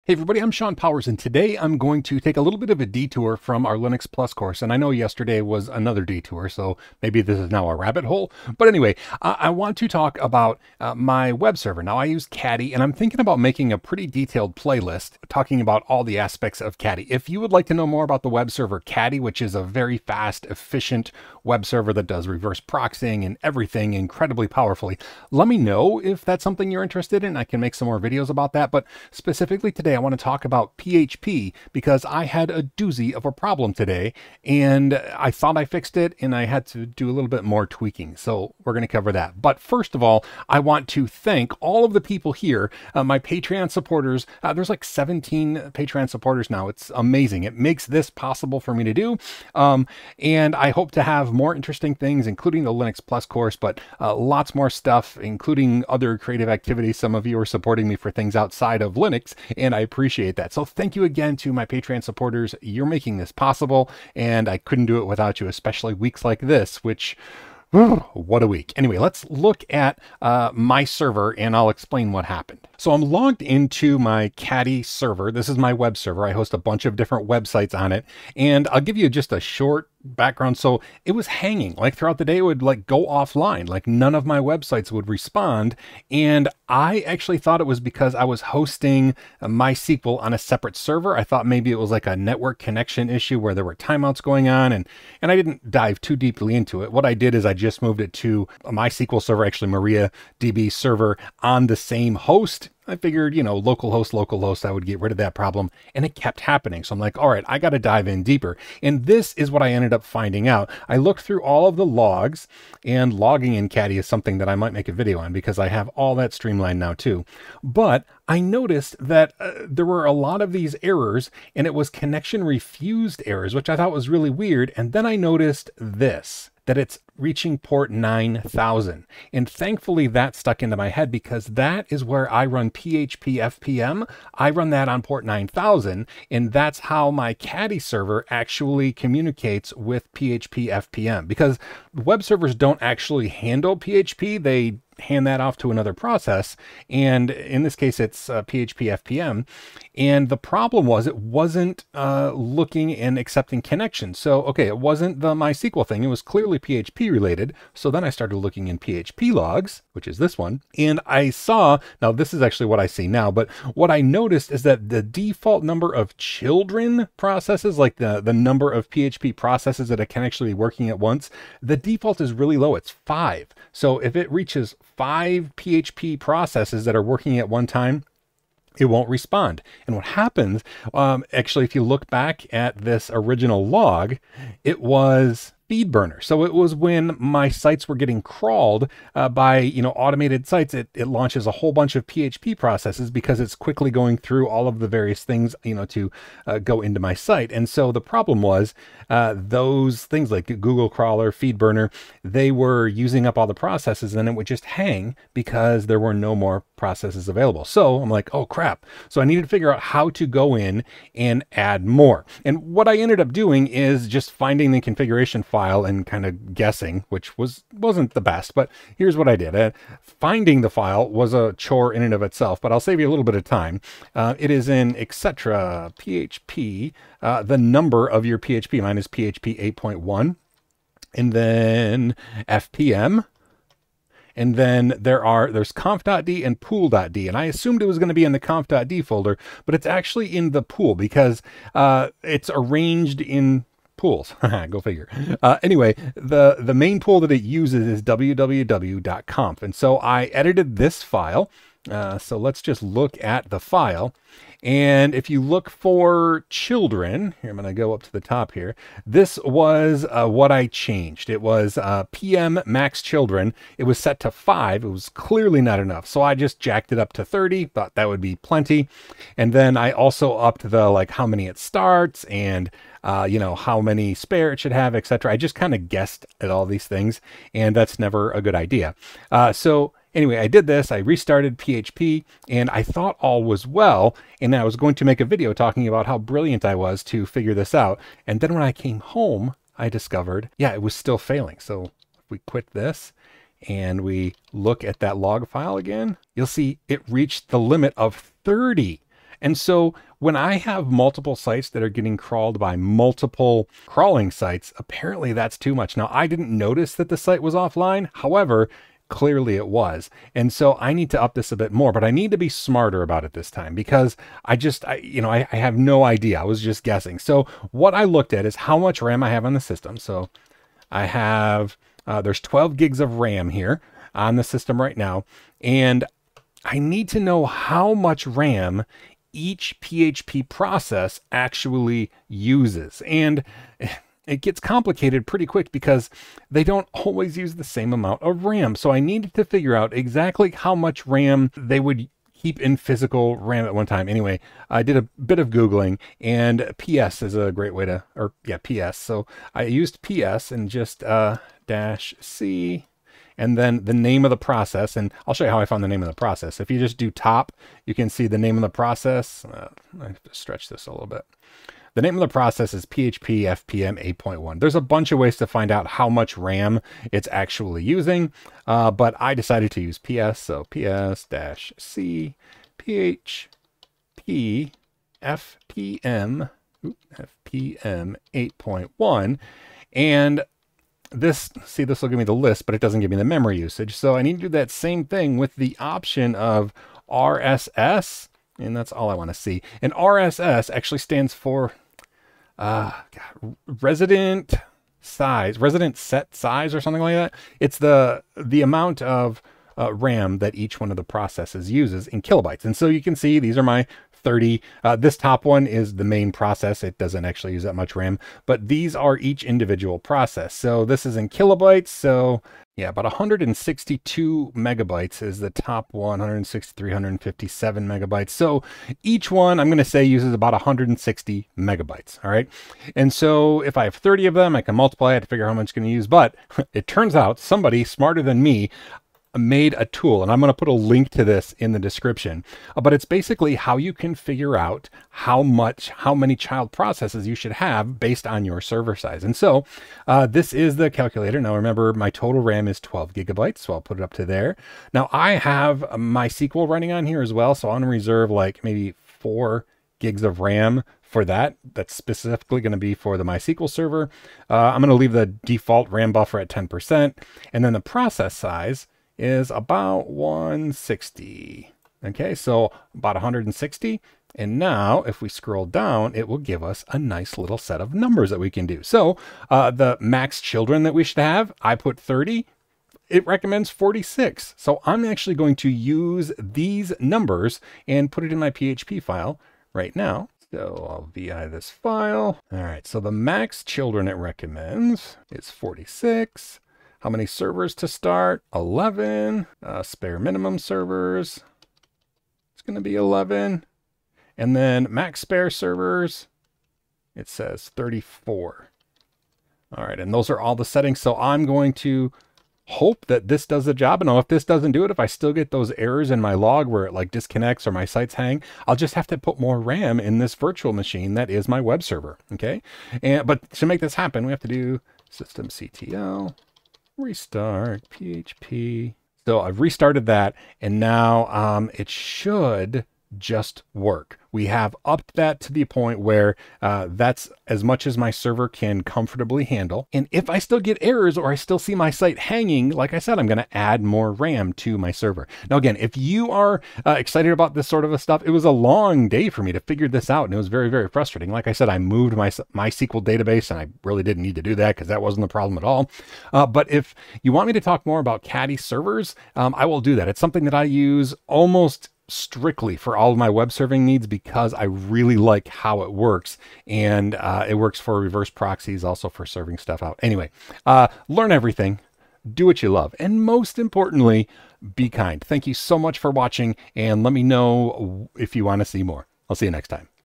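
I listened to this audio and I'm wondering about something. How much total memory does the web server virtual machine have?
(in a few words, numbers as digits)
12 gigs.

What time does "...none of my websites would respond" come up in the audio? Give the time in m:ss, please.
1:23.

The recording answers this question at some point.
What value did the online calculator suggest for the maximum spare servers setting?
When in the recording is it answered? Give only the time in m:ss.
8:17.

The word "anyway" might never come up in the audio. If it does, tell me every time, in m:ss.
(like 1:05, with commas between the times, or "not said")
0:08, 1:08, 4:05, 4:40, 5:44, 9:20.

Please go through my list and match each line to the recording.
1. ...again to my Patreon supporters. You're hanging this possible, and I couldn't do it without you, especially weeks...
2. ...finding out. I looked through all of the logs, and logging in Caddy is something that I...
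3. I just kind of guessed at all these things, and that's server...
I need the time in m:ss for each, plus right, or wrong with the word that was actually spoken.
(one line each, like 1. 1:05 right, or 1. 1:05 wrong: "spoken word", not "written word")
1. 1:01 wrong: "making", not "hanging"
2. 1:50 right
3. 4:35 wrong: "never", not "server".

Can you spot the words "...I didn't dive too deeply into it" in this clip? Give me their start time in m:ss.
1:35.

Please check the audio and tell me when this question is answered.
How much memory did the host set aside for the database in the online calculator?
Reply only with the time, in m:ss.
7:29.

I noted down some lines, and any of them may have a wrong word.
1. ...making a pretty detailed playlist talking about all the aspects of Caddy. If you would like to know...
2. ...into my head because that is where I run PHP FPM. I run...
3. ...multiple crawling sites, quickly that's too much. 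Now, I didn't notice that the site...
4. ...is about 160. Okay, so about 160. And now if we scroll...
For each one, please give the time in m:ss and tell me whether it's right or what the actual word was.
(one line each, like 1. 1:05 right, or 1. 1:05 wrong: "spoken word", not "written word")
1. 0:13 right
2. 2:10 right
3. 5:02 wrong: "apparently", not "quickly"
4. 7:39 right.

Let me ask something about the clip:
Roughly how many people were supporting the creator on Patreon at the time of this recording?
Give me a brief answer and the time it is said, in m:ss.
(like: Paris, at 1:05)
17, at 0:44.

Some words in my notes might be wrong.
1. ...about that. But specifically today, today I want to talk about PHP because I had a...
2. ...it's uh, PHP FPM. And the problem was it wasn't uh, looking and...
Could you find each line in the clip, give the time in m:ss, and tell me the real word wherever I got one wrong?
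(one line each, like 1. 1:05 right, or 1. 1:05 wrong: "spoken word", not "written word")
1. 0:28 right
2. 2:27 right.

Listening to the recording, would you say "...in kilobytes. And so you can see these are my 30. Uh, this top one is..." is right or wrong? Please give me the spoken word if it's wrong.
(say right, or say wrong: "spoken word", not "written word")
right.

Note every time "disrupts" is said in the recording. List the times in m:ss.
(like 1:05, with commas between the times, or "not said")
not said.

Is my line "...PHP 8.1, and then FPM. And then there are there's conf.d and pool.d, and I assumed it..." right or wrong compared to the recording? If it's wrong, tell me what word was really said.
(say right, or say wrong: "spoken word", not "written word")
right.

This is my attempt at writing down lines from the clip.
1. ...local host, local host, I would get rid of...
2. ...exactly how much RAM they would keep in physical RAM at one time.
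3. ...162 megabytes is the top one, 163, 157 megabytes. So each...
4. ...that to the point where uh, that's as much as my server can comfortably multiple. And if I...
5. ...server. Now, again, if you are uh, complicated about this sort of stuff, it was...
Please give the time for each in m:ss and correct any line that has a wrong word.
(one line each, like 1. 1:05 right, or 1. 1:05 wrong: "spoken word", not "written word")
1. 1:43 right
2. 5:39 right
3. 6:53 right
4. 8:45 wrong: "handle", not "multiple"
5. 8:54 wrong: "excited", not "complicated".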